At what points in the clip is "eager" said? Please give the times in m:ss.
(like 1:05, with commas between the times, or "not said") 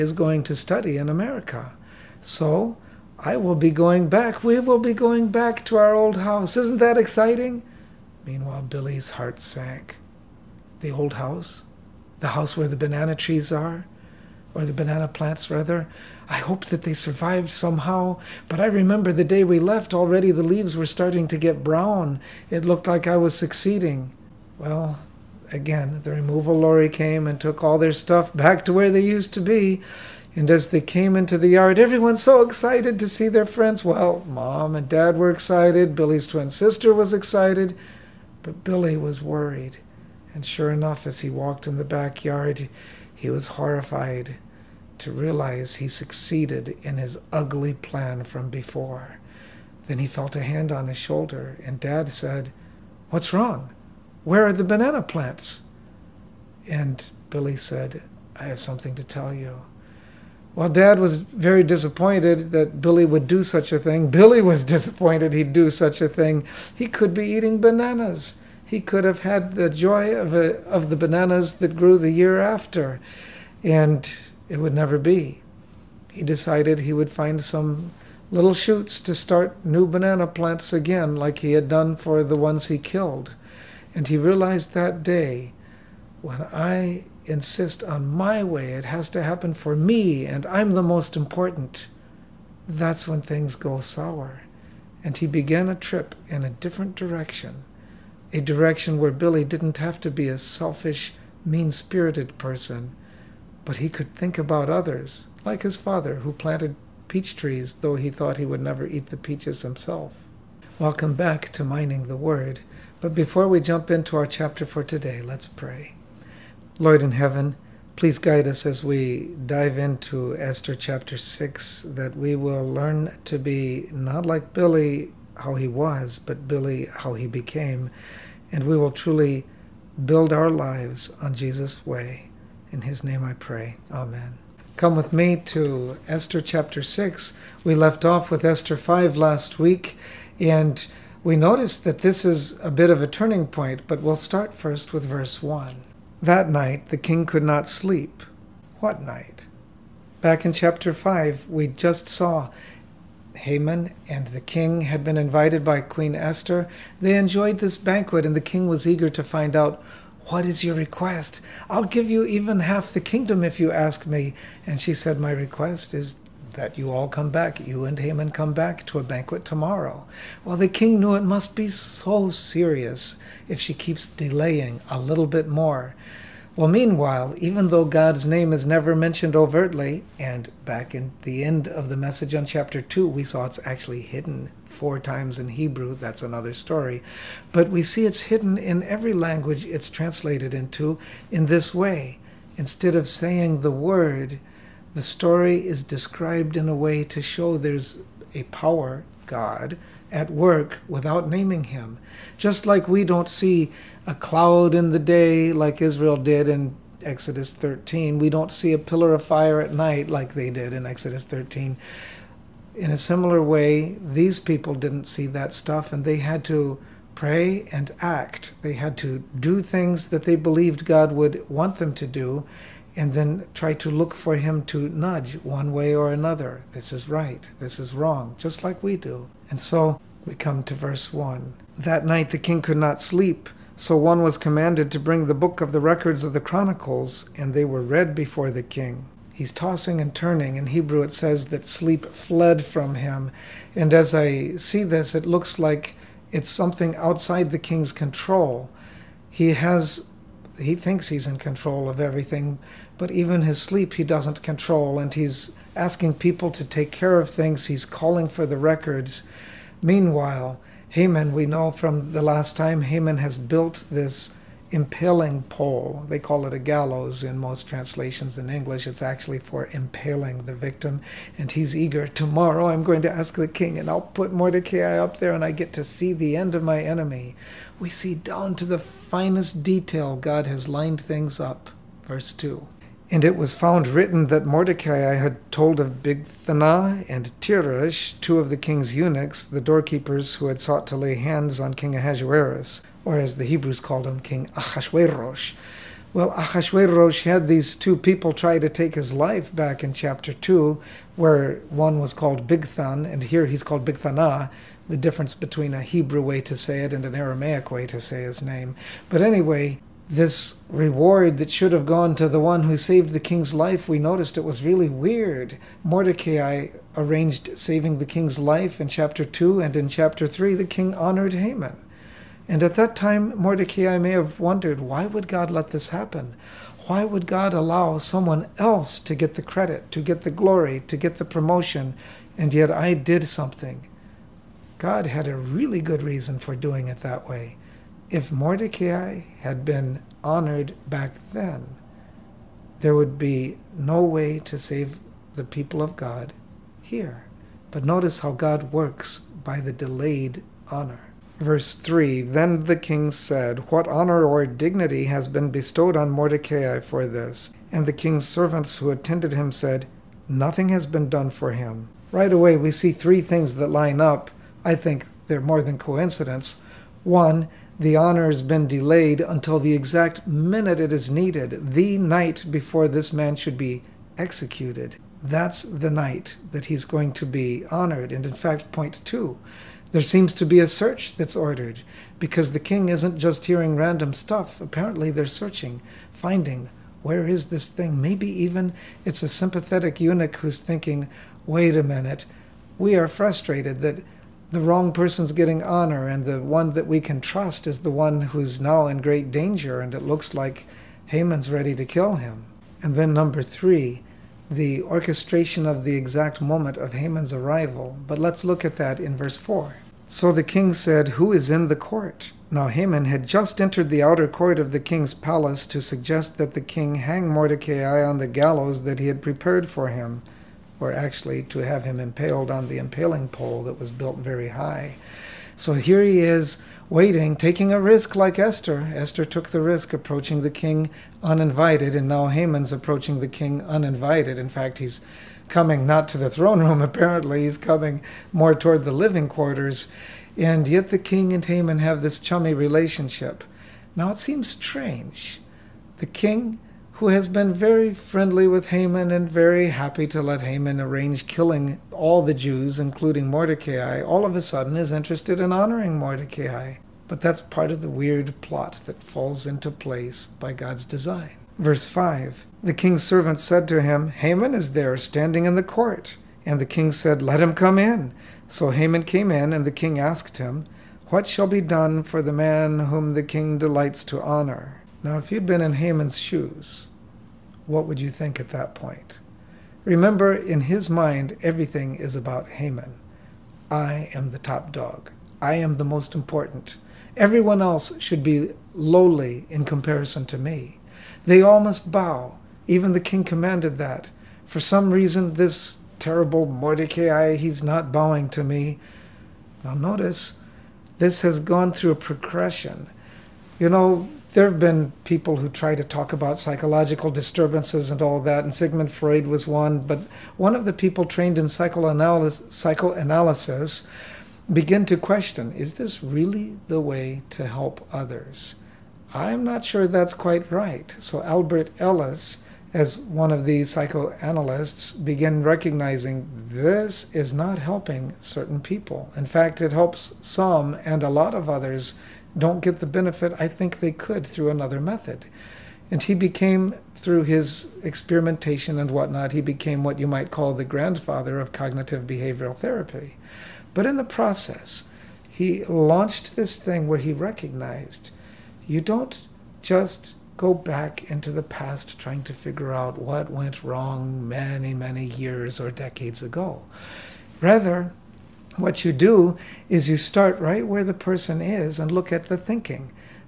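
2:38, 4:31.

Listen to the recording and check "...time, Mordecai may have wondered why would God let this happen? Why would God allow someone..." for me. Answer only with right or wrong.
right.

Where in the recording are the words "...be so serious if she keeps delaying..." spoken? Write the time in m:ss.
2:51.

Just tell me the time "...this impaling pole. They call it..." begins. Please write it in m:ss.
4:23.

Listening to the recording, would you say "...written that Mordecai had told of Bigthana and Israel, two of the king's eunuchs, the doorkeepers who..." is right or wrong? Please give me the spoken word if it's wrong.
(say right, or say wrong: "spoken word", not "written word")
wrong: "Teresh", not "Israel".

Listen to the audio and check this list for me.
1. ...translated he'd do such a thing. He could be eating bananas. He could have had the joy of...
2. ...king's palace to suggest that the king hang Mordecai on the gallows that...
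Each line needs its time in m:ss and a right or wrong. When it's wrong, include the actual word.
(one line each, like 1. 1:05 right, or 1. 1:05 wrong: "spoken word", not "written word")
1. 1:04 wrong: "disappointed", not "translated"
2. 6:54 right.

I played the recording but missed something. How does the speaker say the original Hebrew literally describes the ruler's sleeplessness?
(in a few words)
Sleep fled from him.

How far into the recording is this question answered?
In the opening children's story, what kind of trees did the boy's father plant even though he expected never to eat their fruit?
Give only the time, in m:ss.
1:47.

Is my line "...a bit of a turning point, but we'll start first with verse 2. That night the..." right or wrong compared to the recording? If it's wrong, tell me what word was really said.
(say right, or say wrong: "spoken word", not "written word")
wrong: "1", not "2".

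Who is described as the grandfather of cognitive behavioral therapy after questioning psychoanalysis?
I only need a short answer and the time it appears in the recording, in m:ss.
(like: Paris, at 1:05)
Albert Ellis, at 8:41.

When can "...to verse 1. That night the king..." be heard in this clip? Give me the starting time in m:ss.
3:50.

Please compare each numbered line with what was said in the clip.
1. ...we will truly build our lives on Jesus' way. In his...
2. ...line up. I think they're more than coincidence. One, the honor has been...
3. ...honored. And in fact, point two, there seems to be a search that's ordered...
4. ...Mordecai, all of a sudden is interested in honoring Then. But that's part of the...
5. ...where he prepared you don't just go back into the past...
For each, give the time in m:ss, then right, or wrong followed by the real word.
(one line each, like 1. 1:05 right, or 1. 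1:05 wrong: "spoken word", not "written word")
1. 2:08 right
2. 6:03 right
3. 6:17 right
4. 7:33 wrong: "Mordecai", not "Then"
5. 9:06 wrong: "recognized", not "prepared".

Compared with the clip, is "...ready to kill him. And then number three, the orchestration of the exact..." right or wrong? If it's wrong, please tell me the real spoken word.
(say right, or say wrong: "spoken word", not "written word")
right.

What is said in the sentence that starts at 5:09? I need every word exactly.
But anyway, this reward that should have gone to the one who saved the king's life, we noticed it was really weird.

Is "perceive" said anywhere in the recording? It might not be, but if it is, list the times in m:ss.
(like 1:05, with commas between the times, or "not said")
not said.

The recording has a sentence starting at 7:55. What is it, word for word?
Now, if you'd been in Haman's shoes, what would you think at that point?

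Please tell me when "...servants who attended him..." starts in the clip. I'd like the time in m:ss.
5:58.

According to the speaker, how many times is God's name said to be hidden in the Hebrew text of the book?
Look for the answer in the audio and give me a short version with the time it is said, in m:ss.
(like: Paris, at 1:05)
4, at 3:04.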